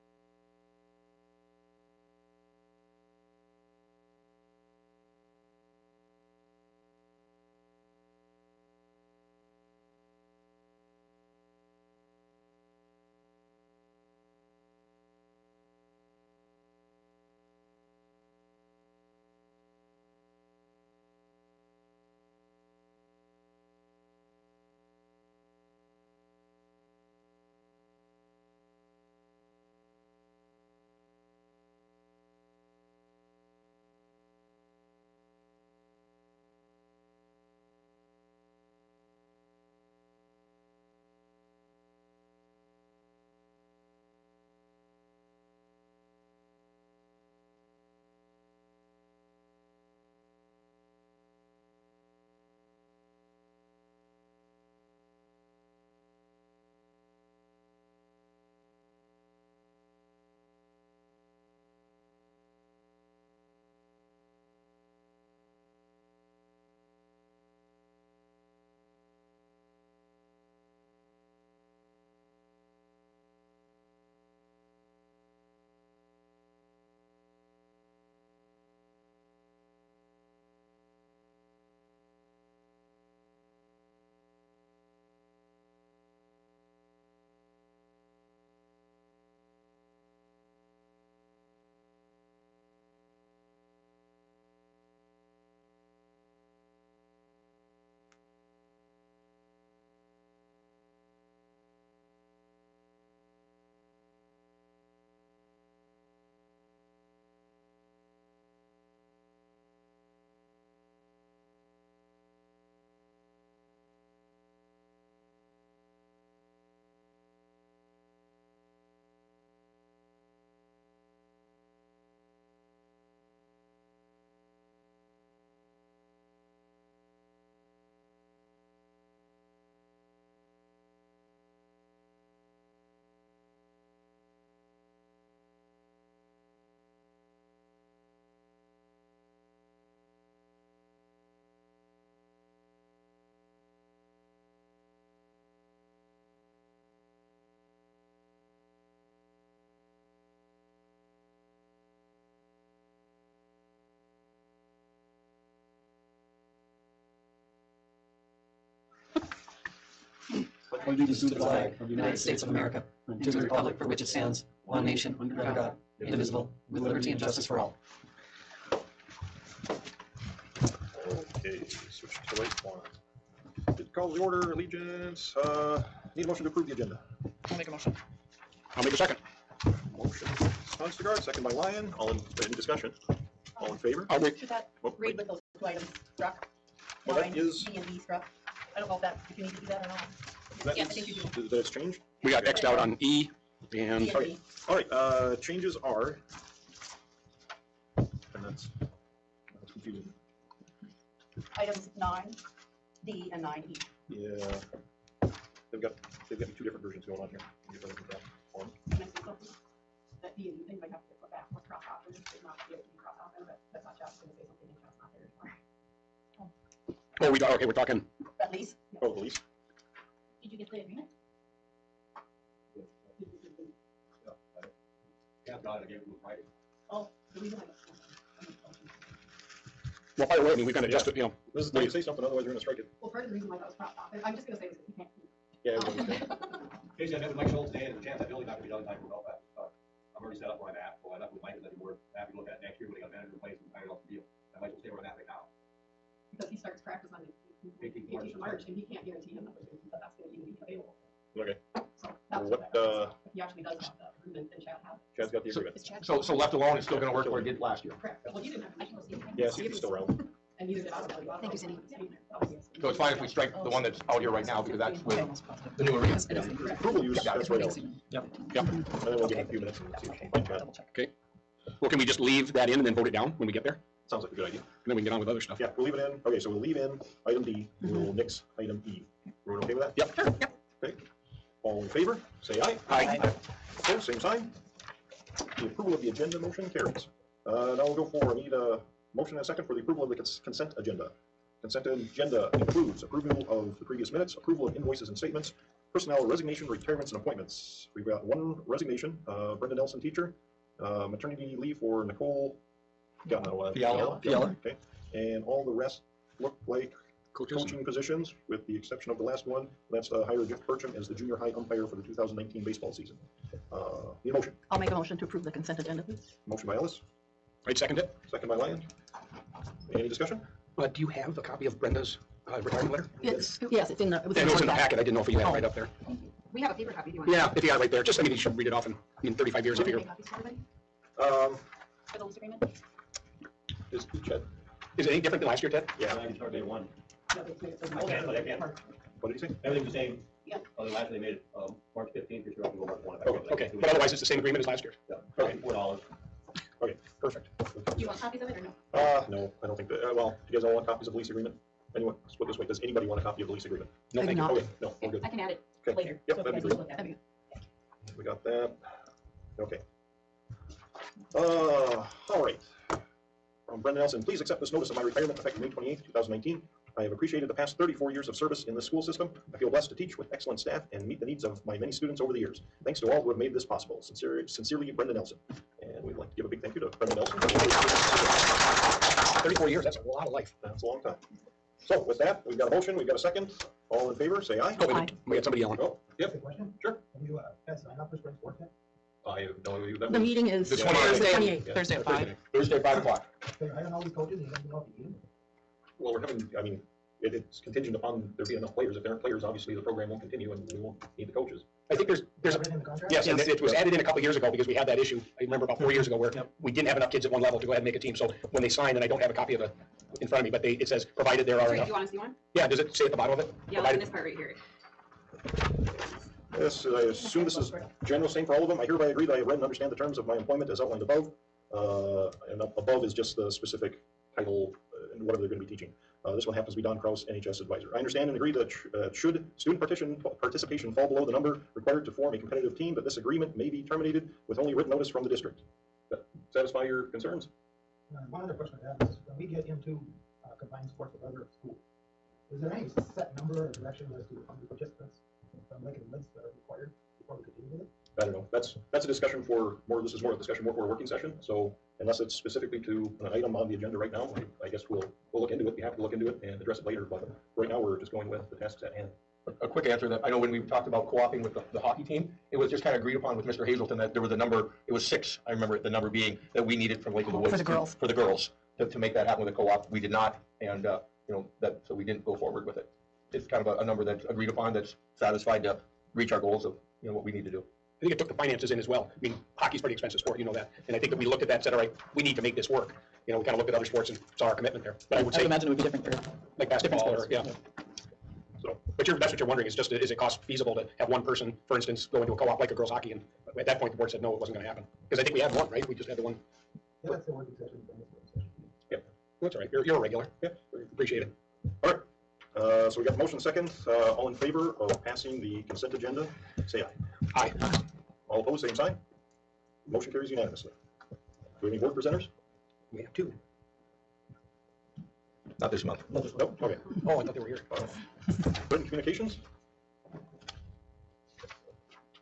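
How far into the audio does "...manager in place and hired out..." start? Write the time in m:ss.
4:03.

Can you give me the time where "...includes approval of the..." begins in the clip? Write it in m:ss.
4:52.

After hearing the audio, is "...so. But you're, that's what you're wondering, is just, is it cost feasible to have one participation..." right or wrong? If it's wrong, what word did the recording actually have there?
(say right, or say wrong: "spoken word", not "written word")
wrong: "person", not "participation".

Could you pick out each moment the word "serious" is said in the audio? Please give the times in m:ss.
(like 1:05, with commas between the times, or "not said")
not said.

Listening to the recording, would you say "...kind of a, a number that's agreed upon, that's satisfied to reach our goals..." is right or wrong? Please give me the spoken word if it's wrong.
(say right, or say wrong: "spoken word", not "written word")
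right.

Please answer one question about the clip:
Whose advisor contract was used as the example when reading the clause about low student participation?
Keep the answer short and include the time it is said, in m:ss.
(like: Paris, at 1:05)
Don Kraus, at 7:06.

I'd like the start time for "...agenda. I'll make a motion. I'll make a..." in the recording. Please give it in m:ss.
2:56.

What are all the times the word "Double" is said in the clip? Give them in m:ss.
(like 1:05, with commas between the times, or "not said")
4:30.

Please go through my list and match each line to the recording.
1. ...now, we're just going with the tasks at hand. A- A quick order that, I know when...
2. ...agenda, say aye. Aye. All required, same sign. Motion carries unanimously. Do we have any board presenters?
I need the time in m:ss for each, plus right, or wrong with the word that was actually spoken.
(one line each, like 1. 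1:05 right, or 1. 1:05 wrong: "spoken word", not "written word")
1. 7:37 wrong: "answer", not "order"
2. 8:25 wrong: "opposed", not "required".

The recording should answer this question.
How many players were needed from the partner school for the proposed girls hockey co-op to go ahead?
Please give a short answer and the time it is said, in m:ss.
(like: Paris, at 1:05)
6, at 7:44.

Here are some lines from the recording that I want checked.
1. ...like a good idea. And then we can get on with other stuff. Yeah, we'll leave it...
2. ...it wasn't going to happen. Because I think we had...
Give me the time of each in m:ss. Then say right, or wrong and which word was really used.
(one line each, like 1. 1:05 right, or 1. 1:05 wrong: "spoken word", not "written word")
1. 4:34 right
2. 8:14 right.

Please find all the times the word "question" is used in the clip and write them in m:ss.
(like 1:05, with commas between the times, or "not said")
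3:18, 6:26, 7:18.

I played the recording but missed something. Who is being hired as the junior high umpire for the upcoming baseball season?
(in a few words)
Jeff Burcham.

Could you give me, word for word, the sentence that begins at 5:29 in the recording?
I mean, thirty-five years, I figure.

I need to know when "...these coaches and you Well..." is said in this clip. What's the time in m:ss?
6:34.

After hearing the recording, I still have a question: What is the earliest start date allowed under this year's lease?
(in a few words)
March 1.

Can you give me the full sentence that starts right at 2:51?
Okay, switch to the right one.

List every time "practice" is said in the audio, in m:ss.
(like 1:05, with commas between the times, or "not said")
3:59, 4:06.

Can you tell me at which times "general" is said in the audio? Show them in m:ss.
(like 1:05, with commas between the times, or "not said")
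6:58.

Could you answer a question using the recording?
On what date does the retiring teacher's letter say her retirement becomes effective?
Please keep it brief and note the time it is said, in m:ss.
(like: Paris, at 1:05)
May 28, 2019, at 6:05.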